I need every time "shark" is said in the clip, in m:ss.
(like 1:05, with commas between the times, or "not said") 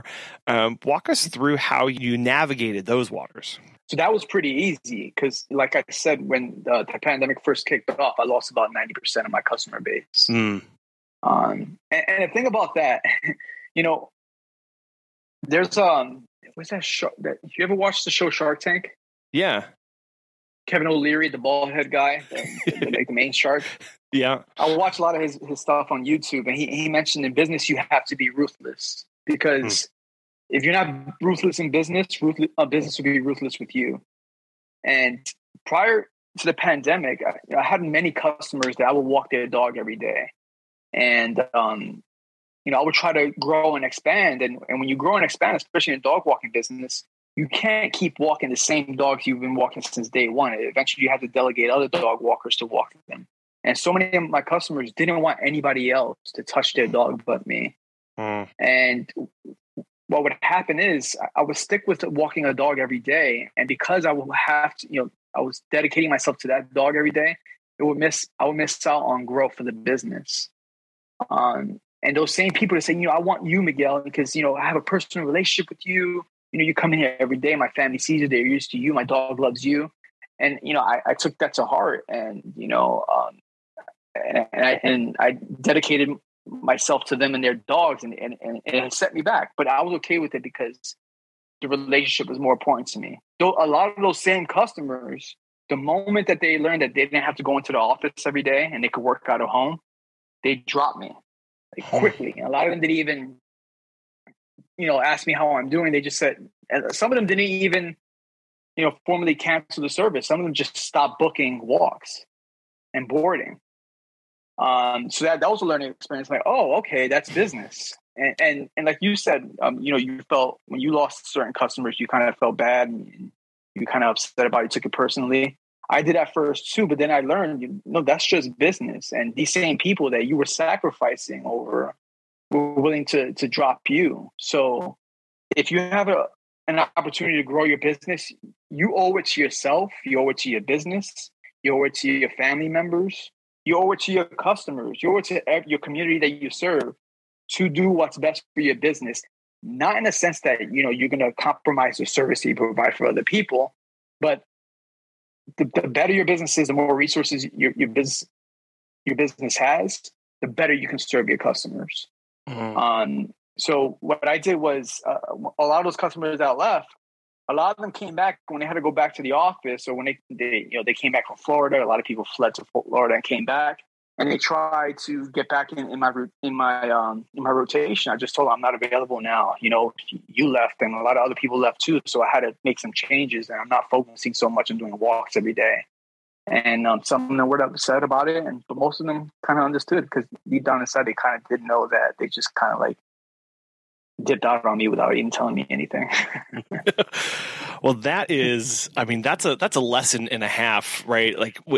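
0:18, 0:23.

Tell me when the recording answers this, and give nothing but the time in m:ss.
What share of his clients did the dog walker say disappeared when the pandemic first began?
0:08.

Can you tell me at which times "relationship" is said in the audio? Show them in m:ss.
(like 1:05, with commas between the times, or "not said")
1:15, 1:31.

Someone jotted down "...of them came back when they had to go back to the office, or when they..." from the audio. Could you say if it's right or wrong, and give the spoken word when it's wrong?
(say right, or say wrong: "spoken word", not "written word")
right.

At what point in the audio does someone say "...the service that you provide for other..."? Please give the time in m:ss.
2:31.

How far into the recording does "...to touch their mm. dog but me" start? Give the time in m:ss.
0:56.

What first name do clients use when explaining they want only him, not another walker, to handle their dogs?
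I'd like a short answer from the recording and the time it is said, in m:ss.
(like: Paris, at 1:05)
Miguel, at 1:13.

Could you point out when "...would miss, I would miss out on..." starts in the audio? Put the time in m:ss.
1:07.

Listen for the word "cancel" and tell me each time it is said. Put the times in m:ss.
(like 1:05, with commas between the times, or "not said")
1:49.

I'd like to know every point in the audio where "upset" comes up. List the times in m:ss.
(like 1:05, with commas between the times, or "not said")
2:04, 3:07.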